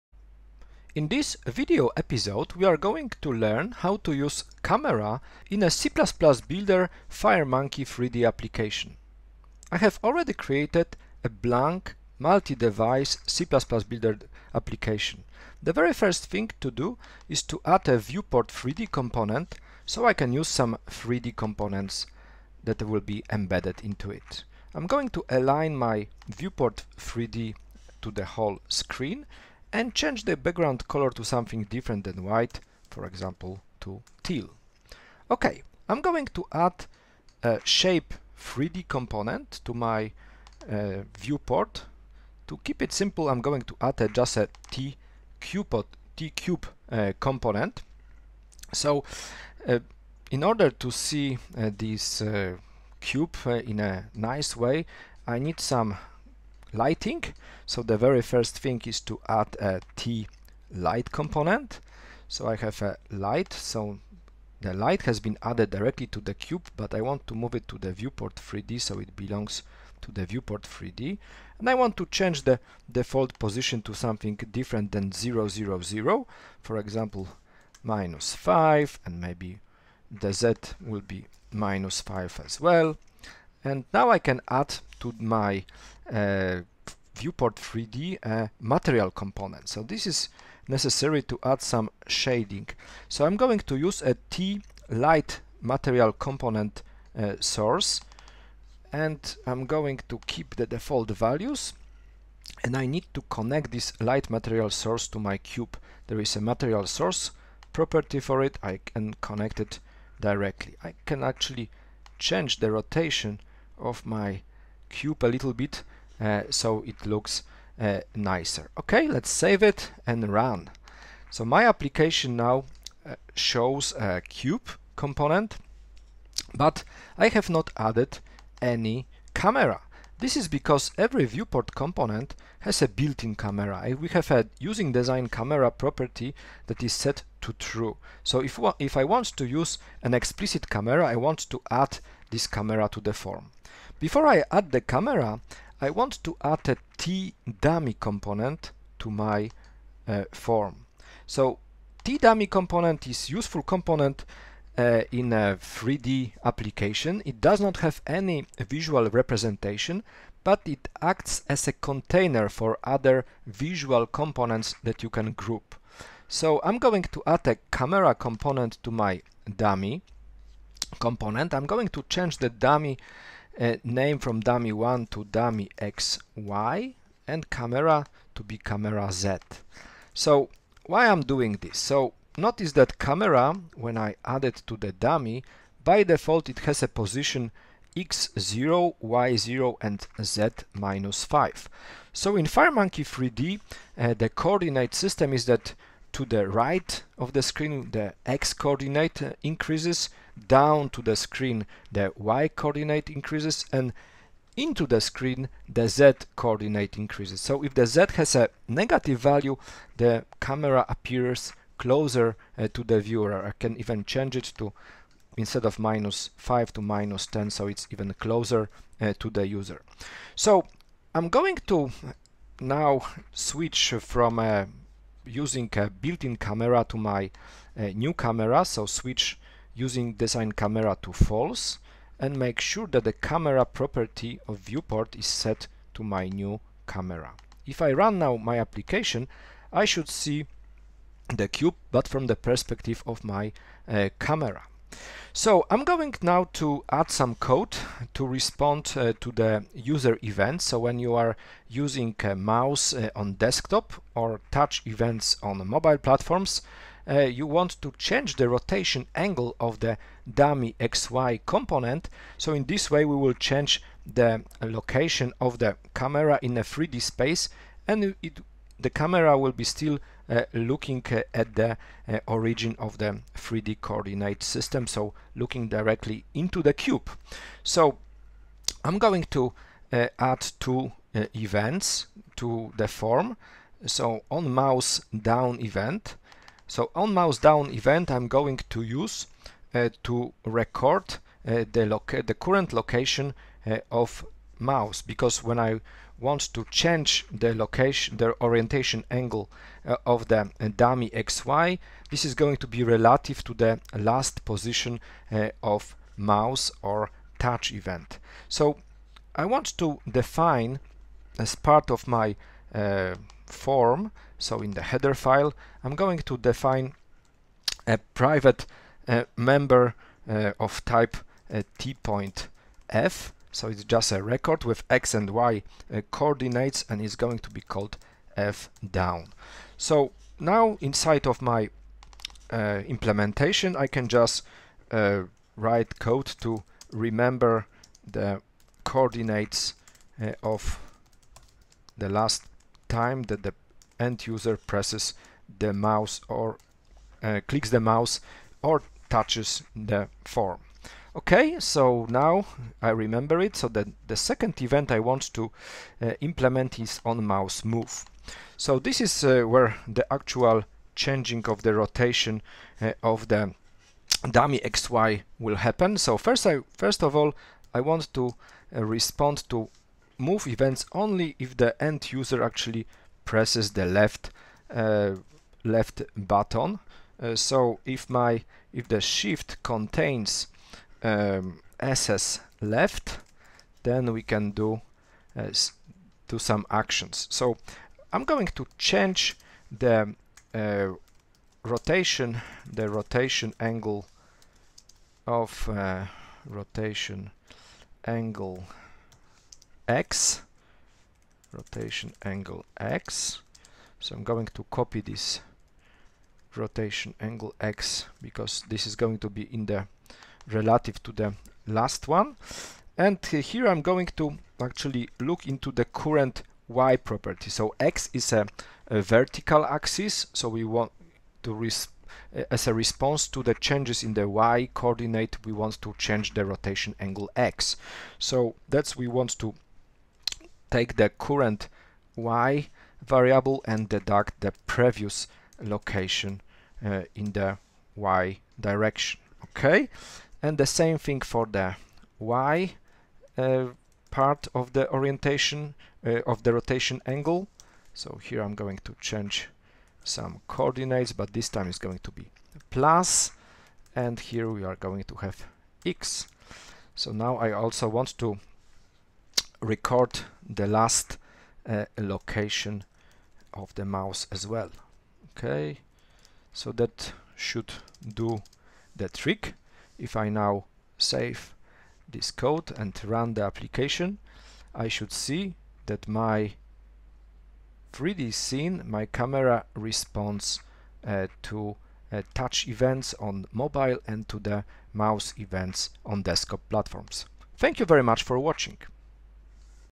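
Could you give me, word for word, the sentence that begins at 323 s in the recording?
So it's just a record with x and y uh, coordinates and is going to be called f down.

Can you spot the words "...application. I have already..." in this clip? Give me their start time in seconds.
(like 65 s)
8 s.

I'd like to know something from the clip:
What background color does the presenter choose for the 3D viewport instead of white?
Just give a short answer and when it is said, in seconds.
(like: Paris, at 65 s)
Teal, at 34 s.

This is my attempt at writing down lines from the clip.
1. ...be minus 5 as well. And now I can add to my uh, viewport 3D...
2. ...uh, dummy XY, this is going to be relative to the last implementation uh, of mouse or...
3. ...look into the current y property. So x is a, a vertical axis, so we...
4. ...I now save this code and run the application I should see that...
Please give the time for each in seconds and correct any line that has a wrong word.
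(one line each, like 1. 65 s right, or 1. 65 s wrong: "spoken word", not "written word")
1. 81 s right
2. 300 s wrong: "position", not "implementation"
3. 415 s right
4. 470 s right.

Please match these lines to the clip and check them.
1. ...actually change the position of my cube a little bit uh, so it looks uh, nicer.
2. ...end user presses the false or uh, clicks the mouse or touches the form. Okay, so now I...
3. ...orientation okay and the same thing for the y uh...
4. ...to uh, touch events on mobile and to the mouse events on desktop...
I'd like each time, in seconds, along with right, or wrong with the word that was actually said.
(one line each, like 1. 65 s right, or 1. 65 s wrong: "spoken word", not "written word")
1. 111 s wrong: "rotation", not "position"
2. 343 s wrong: "mouse", not "false"
3. 438 s wrong: "direction", not "orientation"
4. 481 s right.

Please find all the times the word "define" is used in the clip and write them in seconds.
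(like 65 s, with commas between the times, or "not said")
310 s, 316 s.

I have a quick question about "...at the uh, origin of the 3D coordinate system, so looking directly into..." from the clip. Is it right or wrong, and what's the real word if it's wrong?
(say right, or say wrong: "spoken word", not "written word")
right.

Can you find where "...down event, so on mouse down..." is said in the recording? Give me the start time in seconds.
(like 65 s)
285 s.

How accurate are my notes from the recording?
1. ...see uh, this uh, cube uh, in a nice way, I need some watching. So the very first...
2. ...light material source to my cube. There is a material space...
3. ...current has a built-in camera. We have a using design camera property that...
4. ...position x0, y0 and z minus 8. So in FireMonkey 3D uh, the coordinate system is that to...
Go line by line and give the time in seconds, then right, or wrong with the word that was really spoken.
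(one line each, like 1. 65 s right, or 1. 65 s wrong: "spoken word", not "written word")
1. 50 s wrong: "lighting", not "watching"
2. 104 s wrong: "source", not "space"
3. 131 s wrong: "component", not "current"
4. 186 s wrong: "5", not "8".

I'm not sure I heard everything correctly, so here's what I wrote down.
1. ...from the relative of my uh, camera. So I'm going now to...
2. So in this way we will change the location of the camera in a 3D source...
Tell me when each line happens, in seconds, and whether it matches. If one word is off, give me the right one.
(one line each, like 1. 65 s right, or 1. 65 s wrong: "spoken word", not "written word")
1. 242 s wrong: "perspective", not "relative"
2. 262 s wrong: "space", not "source".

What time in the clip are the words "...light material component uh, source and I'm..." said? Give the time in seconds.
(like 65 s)
94 s.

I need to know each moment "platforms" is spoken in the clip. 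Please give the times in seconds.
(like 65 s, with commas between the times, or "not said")
255 s, 486 s.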